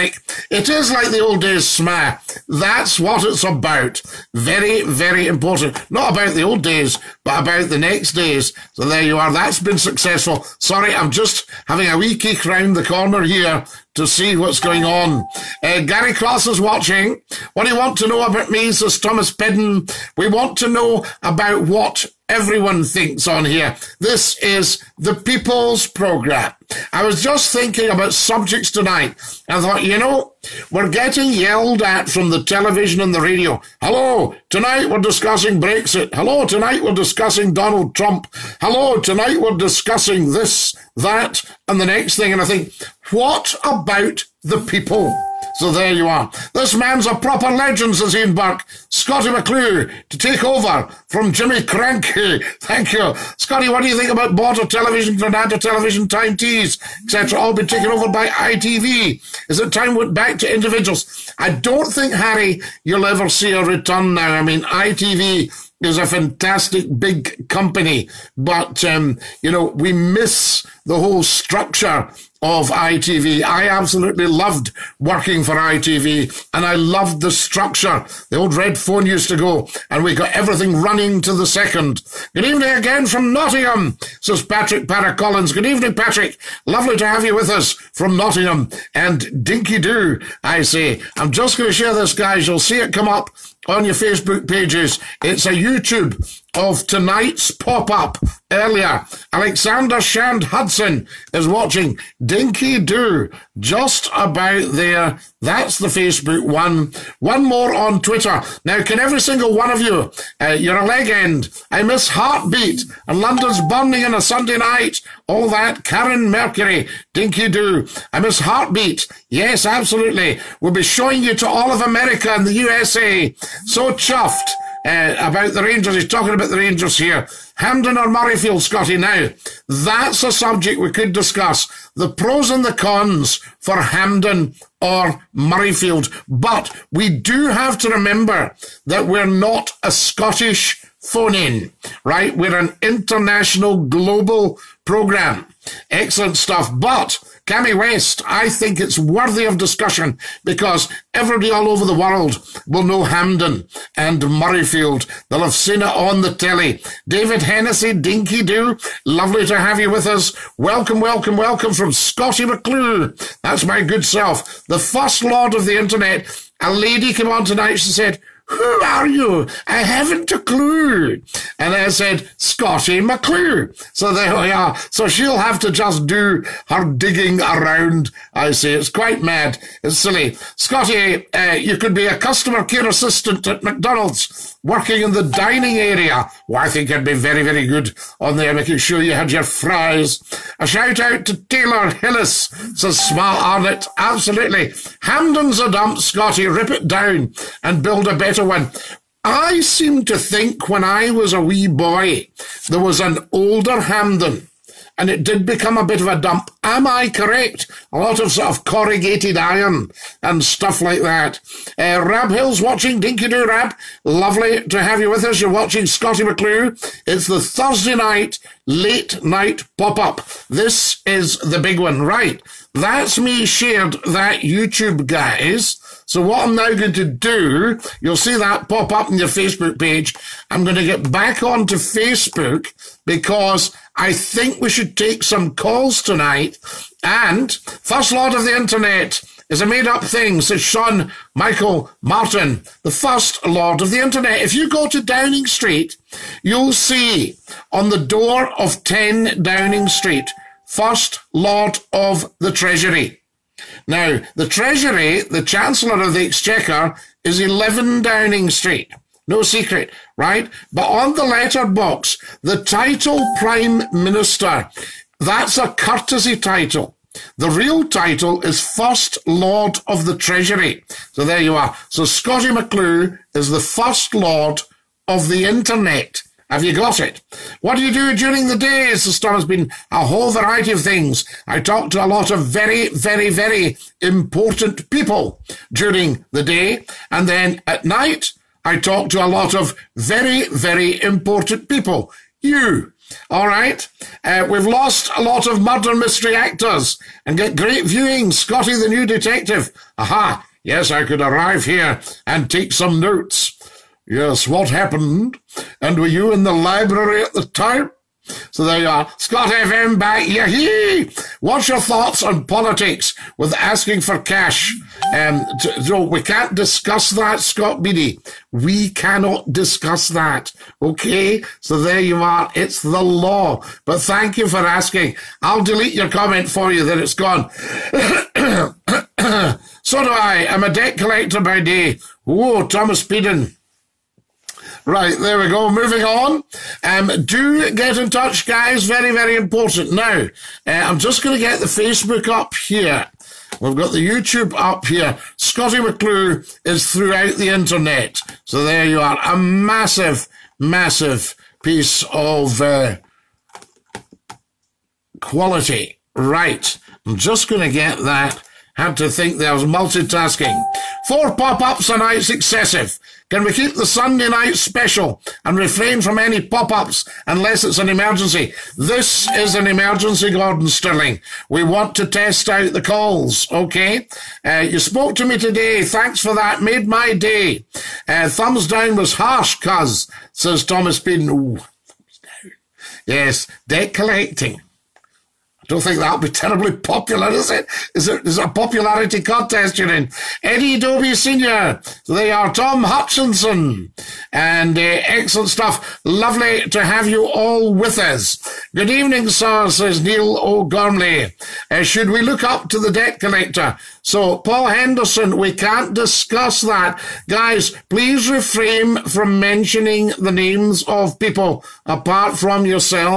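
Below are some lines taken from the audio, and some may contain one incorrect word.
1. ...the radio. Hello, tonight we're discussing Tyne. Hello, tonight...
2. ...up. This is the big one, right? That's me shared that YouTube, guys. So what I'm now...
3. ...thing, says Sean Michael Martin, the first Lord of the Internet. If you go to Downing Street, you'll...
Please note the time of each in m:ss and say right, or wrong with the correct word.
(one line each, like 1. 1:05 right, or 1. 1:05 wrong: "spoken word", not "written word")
1. 0:33 wrong: "Brexit", not "Tyne"
2. 3:39 right
3. 4:00 right.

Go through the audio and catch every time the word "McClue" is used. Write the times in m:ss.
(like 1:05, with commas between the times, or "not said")
0:49, 2:42, 2:52, 3:36, 4:32, 5:45.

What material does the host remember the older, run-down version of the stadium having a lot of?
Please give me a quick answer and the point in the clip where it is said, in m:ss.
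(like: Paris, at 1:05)
corrugated iron, at 3:28.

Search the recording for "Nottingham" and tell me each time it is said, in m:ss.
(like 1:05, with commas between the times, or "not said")
1:23, 1:28.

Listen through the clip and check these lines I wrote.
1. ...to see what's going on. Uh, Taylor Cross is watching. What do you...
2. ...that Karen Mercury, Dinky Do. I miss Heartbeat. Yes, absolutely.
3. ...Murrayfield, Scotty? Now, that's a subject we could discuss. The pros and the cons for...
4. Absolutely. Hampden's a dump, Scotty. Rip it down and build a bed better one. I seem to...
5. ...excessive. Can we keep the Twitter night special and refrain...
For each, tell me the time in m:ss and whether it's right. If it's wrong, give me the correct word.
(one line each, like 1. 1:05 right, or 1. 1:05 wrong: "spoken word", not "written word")
1. 0:13 wrong: "Gary", not "Taylor"
2. 1:55 right
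3. 2:08 right
4. 3:13 right
5. 6:02 wrong: "Sunday", not "Twitter".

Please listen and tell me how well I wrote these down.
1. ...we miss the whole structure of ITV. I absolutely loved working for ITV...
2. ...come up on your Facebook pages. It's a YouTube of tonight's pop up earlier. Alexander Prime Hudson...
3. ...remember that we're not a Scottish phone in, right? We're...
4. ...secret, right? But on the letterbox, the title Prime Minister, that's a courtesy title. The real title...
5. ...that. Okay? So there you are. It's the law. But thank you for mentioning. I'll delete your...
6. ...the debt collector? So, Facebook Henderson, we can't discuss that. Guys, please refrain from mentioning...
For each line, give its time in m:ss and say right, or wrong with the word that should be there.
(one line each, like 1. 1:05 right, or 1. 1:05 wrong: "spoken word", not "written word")
1. 1:09 right
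2. 1:32 wrong: "Shand", not "Prime"
3. 2:17 right
4. 4:19 right
5. 5:20 wrong: "asking", not "mentioning"
6. 6:42 wrong: "Paul", not "Facebook".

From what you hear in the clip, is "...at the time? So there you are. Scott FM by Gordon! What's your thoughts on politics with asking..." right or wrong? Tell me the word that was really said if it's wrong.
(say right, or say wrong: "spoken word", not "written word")
wrong: "Yahee", not "Gordon".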